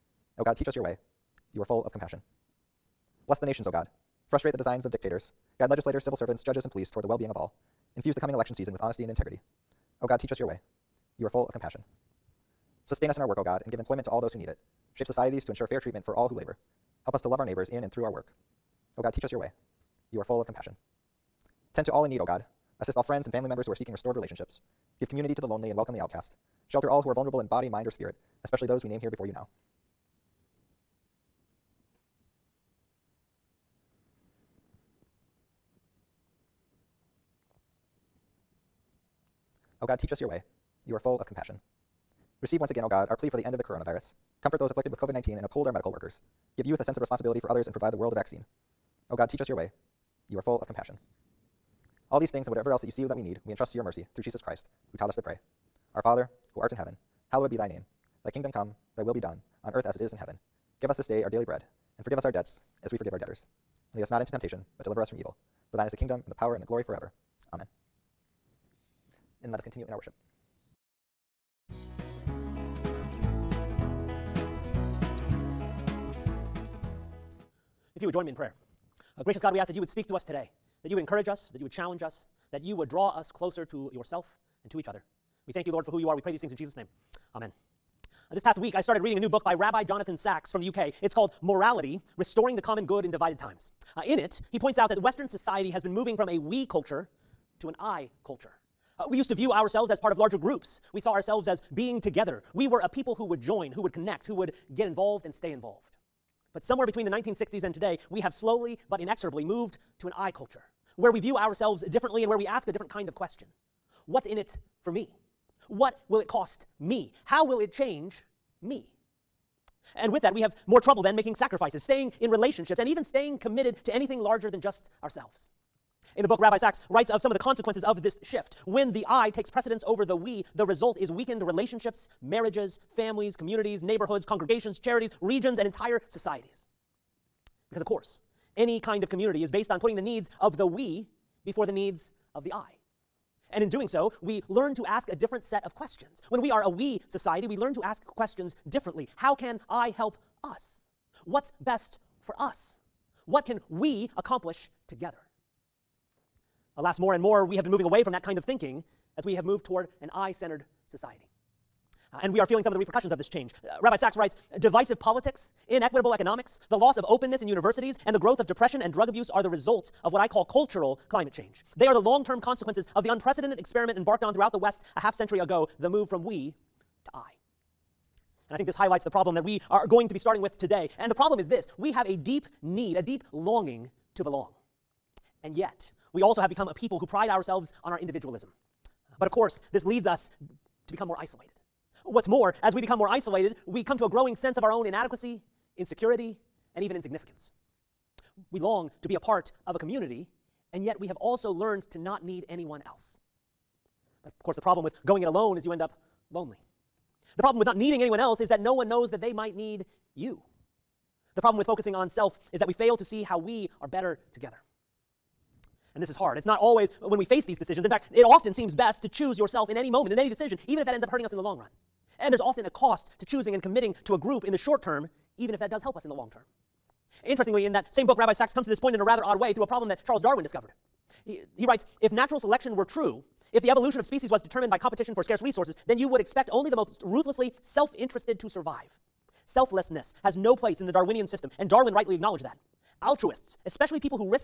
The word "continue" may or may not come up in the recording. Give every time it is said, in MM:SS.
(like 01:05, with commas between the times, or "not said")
01:09.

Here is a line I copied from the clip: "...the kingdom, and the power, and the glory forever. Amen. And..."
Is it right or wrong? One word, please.
right.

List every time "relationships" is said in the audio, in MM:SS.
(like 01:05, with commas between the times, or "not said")
00:24, 02:02, 02:11.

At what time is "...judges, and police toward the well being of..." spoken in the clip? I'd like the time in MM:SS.
00:06.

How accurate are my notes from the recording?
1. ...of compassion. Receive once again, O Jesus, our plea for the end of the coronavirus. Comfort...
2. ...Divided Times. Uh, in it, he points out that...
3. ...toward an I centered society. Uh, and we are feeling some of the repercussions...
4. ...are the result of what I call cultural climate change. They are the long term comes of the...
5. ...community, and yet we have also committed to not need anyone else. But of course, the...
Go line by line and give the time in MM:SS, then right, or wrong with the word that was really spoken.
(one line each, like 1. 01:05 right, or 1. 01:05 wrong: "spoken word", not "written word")
1. 00:41 wrong: "God", not "Jesus"
2. 01:33 right
3. 02:39 right
4. 02:49 wrong: "consequences", not "comes"
5. 03:19 wrong: "learned", not "committed".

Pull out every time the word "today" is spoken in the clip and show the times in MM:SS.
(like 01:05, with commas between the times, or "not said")
01:20, 01:47, 03:00.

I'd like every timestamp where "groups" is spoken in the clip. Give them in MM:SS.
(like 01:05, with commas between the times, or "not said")
01:40, 03:44.